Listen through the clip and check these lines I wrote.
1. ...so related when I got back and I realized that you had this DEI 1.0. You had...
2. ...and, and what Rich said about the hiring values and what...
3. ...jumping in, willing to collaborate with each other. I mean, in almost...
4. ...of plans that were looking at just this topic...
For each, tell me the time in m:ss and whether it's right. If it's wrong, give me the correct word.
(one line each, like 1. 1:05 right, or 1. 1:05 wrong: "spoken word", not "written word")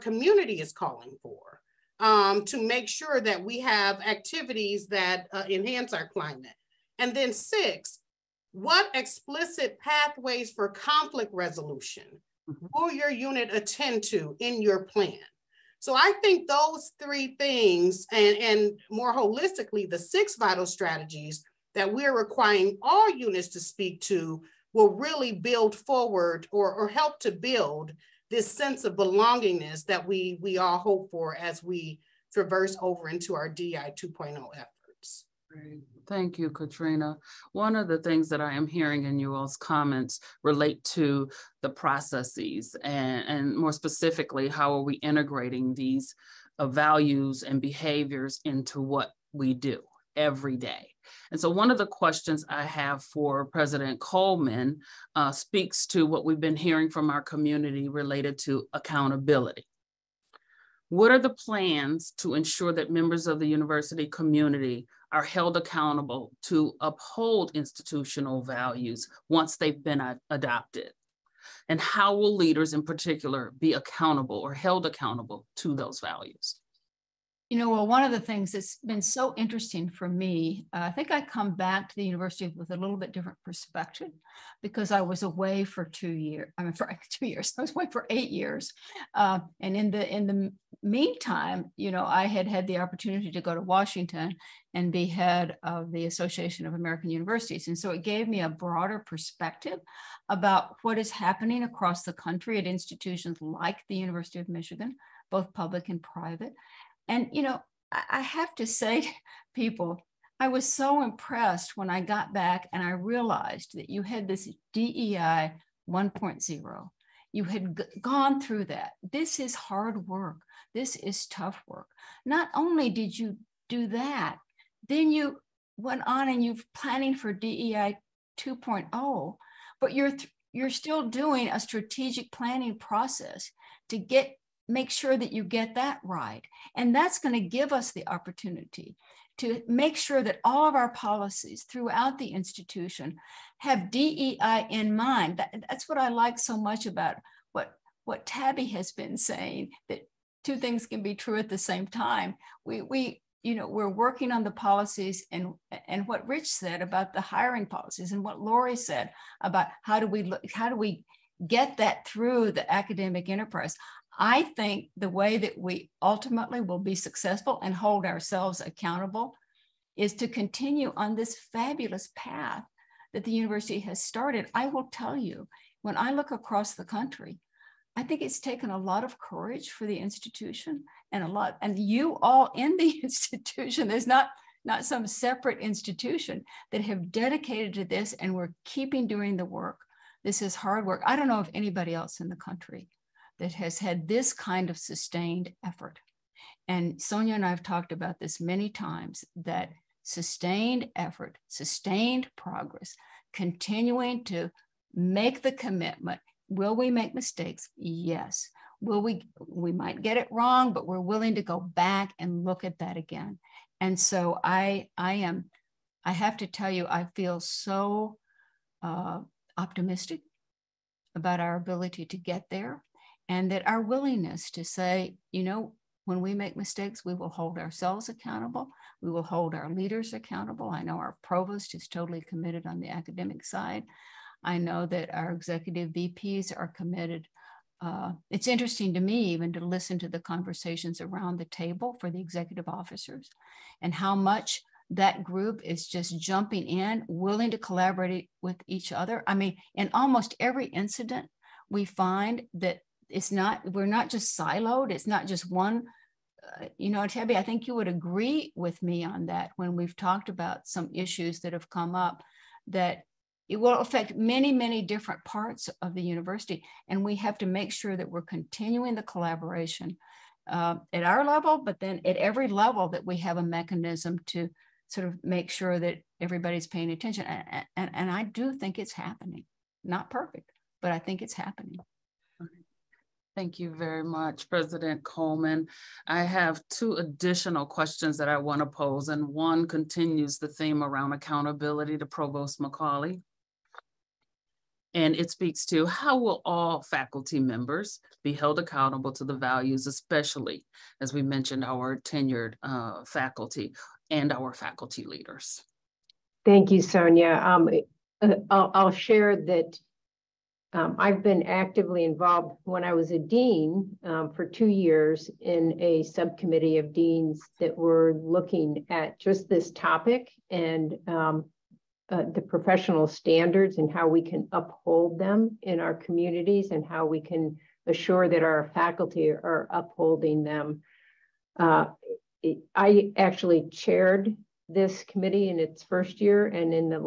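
1. 1:50 wrong: "impressed", not "related"
2. 2:35 wrong: "policies", not "values"
3. 4:06 right
4. 5:16 wrong: "deans", not "plans".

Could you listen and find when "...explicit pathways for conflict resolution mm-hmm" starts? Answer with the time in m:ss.
0:08.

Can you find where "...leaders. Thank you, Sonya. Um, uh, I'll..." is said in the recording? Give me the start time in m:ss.
5:05.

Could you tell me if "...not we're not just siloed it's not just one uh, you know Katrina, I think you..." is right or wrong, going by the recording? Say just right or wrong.
wrong.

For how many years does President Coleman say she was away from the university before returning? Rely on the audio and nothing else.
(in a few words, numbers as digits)
8.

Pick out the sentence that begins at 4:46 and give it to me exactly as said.
I have two additional questions that I want to pose, and one continues the theme around accountability to Provost McCauley.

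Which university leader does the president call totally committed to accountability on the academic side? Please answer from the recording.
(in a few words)
our provost.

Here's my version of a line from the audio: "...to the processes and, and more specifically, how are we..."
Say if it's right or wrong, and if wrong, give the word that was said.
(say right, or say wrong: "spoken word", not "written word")
right.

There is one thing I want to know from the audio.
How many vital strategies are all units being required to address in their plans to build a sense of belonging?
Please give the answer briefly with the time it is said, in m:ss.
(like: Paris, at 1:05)
6, at 0:19.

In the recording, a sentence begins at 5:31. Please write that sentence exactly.
Uh, I actually chaired this committee in its first year.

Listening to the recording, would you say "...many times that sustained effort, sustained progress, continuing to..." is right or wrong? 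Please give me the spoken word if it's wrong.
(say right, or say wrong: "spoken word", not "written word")
right.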